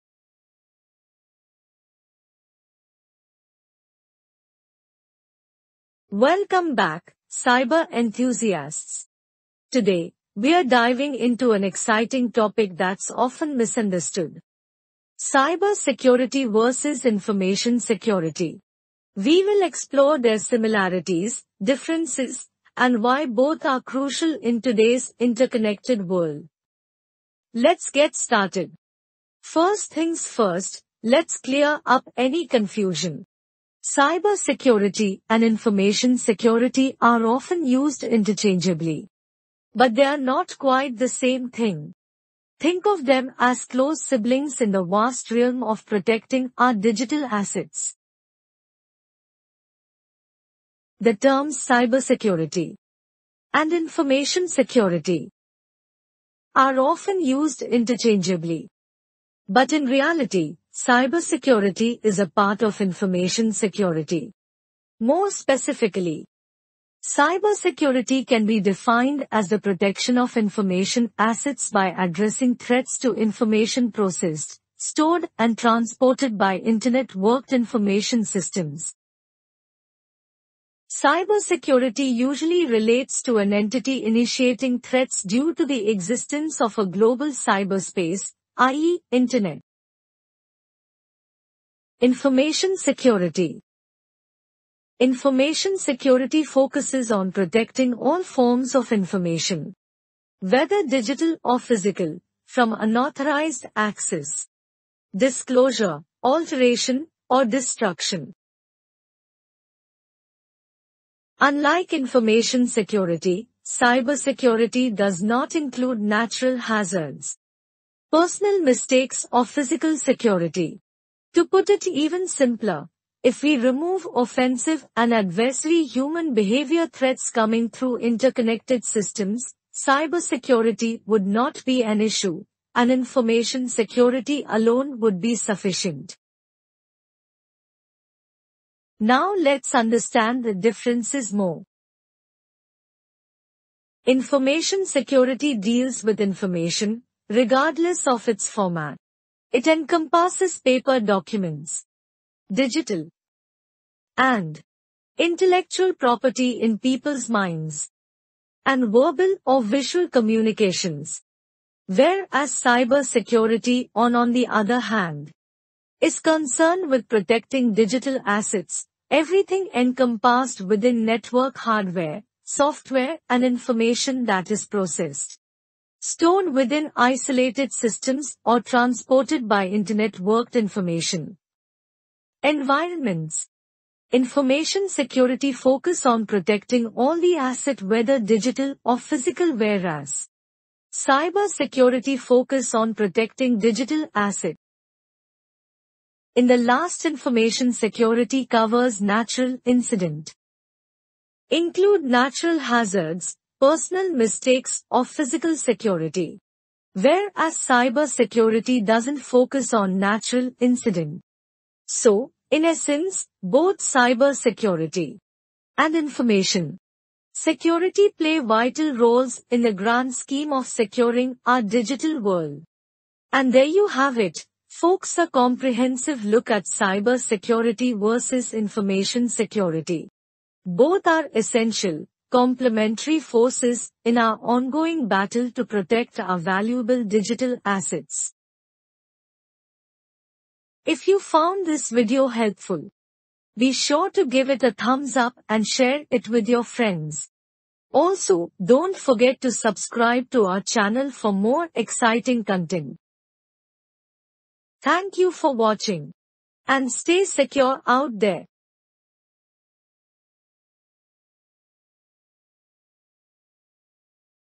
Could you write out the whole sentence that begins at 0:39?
But they are not quite the same thing.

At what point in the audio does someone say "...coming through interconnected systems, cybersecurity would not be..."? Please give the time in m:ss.
2:07.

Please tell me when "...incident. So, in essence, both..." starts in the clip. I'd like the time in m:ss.
3:30.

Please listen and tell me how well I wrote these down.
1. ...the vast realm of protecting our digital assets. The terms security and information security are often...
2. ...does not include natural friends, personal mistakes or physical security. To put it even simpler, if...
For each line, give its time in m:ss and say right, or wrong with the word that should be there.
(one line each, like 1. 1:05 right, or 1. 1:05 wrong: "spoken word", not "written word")
1. 0:44 wrong: "cybersecurity", not "security"
2. 1:54 wrong: "hazards", not "friends".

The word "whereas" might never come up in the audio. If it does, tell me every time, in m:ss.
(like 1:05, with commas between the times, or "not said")
2:41, 3:09, 3:26.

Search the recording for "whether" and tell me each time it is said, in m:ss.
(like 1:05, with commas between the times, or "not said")
1:40, 3:07.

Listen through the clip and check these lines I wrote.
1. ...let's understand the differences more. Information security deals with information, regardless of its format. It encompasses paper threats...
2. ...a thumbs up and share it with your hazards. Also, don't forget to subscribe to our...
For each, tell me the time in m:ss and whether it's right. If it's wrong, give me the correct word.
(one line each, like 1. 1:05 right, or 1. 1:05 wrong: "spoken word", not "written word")
1. 2:19 wrong: "documents", not "threats"
2. 4:04 wrong: "friends", not "hazards".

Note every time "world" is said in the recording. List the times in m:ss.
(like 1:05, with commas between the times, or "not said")
0:26, 3:42.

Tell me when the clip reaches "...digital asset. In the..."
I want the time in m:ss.
3:13.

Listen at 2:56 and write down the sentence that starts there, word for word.
Stored within isolated systems or transported by internet-worked information.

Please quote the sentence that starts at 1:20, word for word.
Cybersecurity usually relates to an entity initiating threats due to the existence of a global cyberspace, i.e.